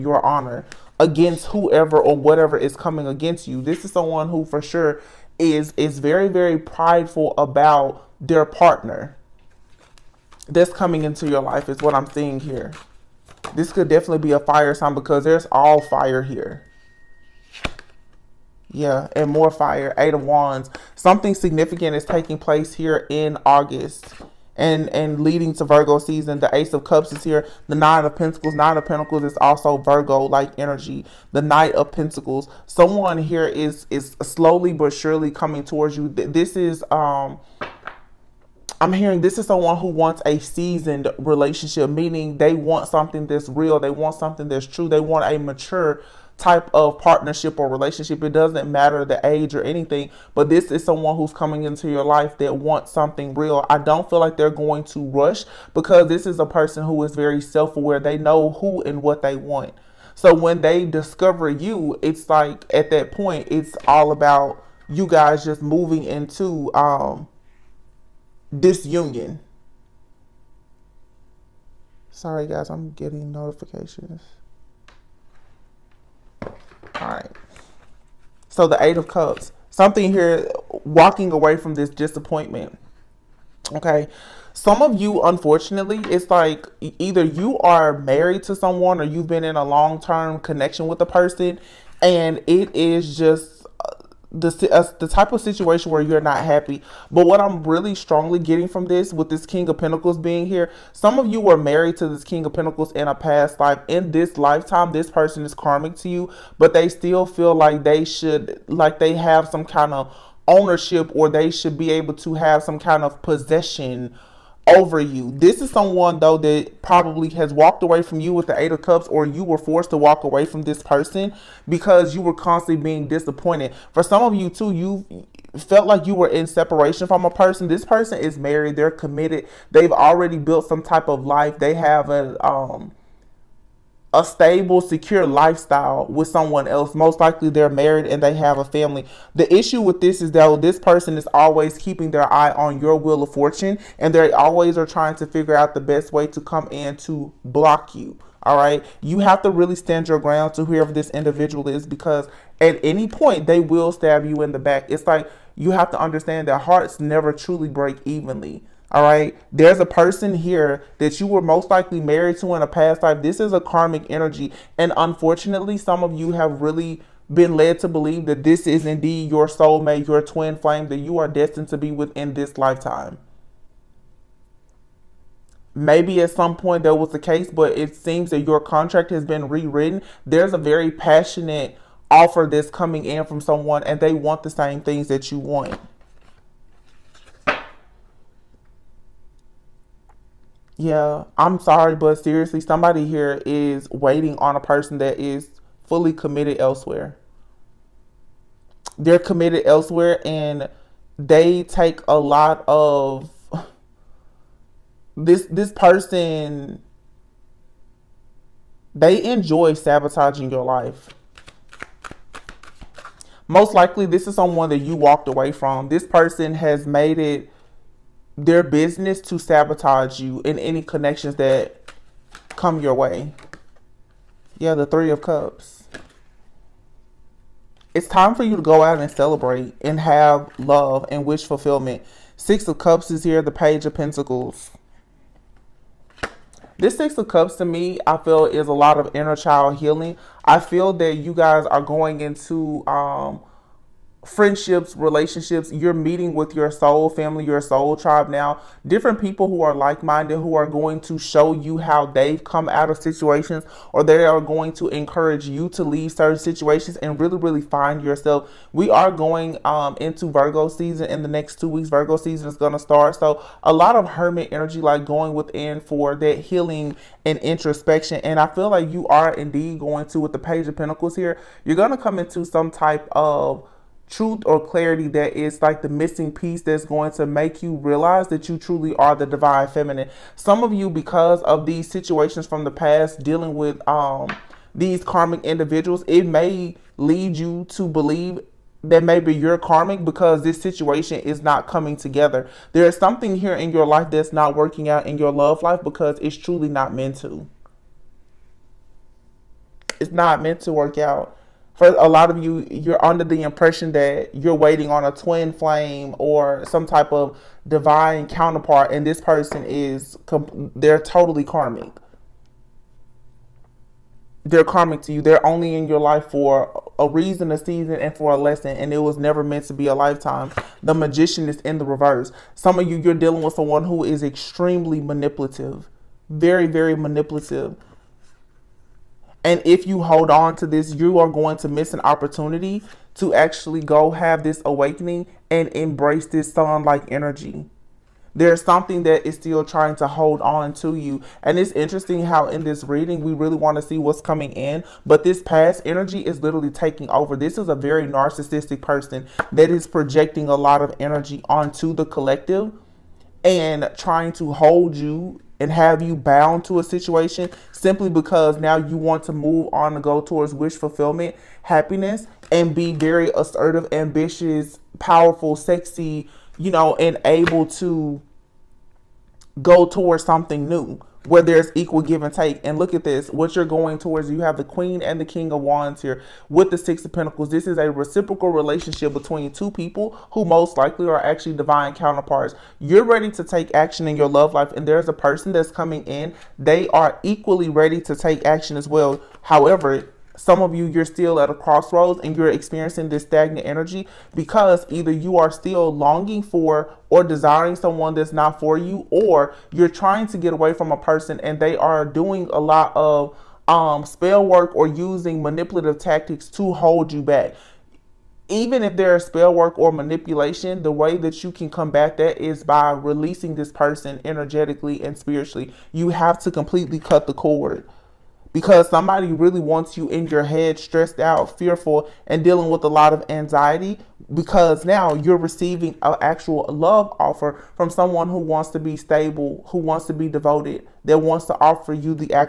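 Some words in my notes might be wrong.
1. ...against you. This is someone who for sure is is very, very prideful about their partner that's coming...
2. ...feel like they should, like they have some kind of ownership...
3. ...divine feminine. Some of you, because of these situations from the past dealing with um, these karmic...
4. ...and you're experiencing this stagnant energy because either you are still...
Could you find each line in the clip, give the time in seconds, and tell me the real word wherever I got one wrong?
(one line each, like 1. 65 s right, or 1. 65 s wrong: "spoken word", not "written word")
1. 3 s right
2. 107 s right
3. 279 s right
4. 392 s right.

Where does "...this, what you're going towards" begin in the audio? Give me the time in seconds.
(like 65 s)
373 s.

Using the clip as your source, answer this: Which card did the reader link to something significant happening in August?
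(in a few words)
Eight of Wands.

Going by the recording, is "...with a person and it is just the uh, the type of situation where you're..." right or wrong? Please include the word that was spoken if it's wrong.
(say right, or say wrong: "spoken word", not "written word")
right.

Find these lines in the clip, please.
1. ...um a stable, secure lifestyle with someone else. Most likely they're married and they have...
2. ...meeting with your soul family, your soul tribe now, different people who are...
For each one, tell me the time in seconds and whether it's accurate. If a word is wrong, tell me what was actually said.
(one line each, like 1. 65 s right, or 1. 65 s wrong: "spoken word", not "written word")
1. 132 s right
2. 245 s right.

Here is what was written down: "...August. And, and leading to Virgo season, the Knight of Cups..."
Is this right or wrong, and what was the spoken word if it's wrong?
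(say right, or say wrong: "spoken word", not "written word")
wrong: "Ace", not "Knight".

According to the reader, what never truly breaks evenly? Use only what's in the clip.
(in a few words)
Hearts.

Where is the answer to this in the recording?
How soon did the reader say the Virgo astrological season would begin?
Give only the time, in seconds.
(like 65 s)
261 s.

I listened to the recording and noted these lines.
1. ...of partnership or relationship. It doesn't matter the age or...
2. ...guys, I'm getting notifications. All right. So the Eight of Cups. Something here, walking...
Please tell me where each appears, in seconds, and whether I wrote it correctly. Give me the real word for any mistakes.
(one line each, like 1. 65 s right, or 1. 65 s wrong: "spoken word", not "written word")
1. 46 s right
2. 72 s right.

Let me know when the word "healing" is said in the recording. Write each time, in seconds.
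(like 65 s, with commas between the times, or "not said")
239 s, 266 s.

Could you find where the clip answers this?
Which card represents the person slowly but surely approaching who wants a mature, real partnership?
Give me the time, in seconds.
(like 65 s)
31 s.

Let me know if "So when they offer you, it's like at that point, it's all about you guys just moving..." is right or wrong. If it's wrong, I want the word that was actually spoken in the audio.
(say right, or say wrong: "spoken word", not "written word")
wrong: "discover", not "offer".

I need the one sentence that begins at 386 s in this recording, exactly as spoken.
They are equally ready to take action as well.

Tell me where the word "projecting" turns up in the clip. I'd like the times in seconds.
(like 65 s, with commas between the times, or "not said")
349 s.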